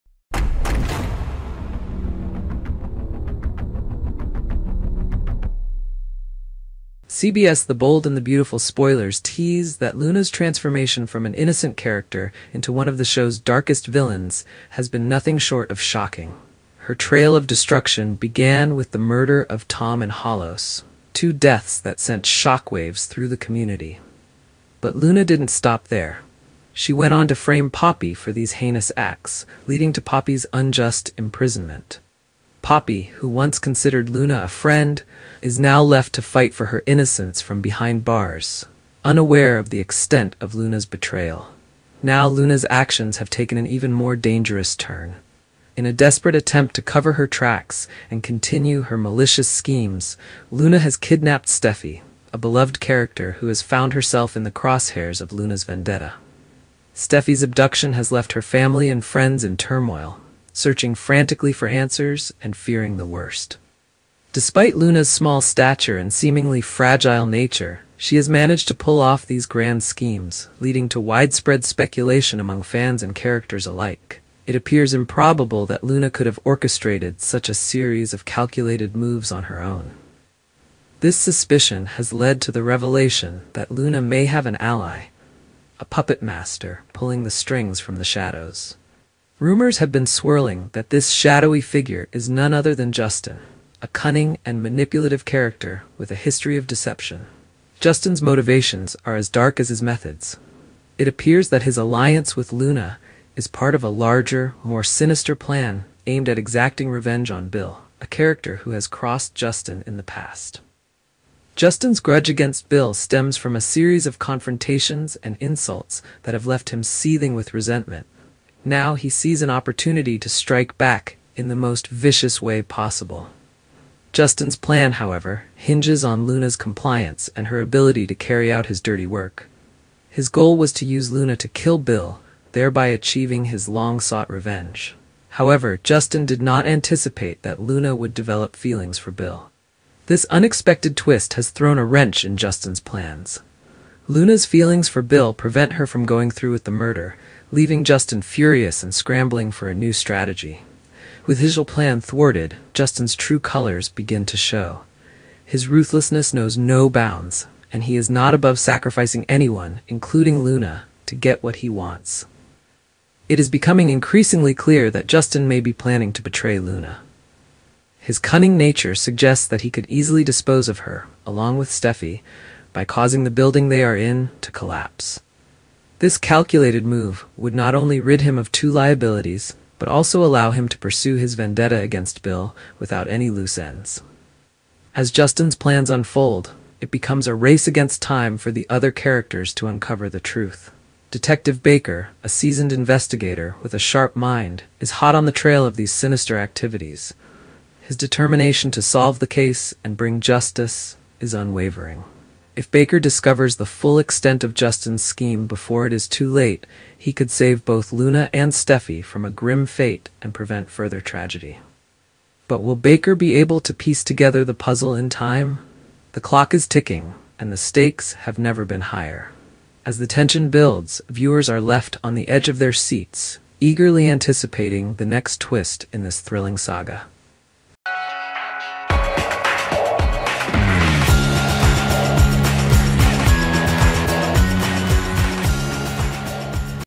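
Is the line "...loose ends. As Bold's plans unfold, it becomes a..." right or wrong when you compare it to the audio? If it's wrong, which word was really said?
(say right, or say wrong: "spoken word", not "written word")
wrong: "Justin", not "Bold".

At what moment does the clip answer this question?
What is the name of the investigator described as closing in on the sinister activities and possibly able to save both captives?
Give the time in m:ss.
3:11.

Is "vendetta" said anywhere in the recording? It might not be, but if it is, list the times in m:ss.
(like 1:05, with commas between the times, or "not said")
0:55, 3:01.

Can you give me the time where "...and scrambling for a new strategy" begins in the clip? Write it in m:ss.
2:28.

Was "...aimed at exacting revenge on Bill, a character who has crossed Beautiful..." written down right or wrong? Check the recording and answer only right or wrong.
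wrong.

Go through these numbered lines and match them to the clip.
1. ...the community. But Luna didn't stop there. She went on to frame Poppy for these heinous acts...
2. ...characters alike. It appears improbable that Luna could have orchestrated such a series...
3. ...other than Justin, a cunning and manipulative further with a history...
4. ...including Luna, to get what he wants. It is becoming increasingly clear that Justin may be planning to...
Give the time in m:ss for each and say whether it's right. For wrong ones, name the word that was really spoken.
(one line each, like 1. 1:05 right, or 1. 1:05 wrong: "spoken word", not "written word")
1. 0:23 right
2. 1:13 right
3. 1:32 wrong: "character", not "further"
4. 2:39 right.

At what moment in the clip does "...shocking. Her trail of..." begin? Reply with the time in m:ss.
0:15.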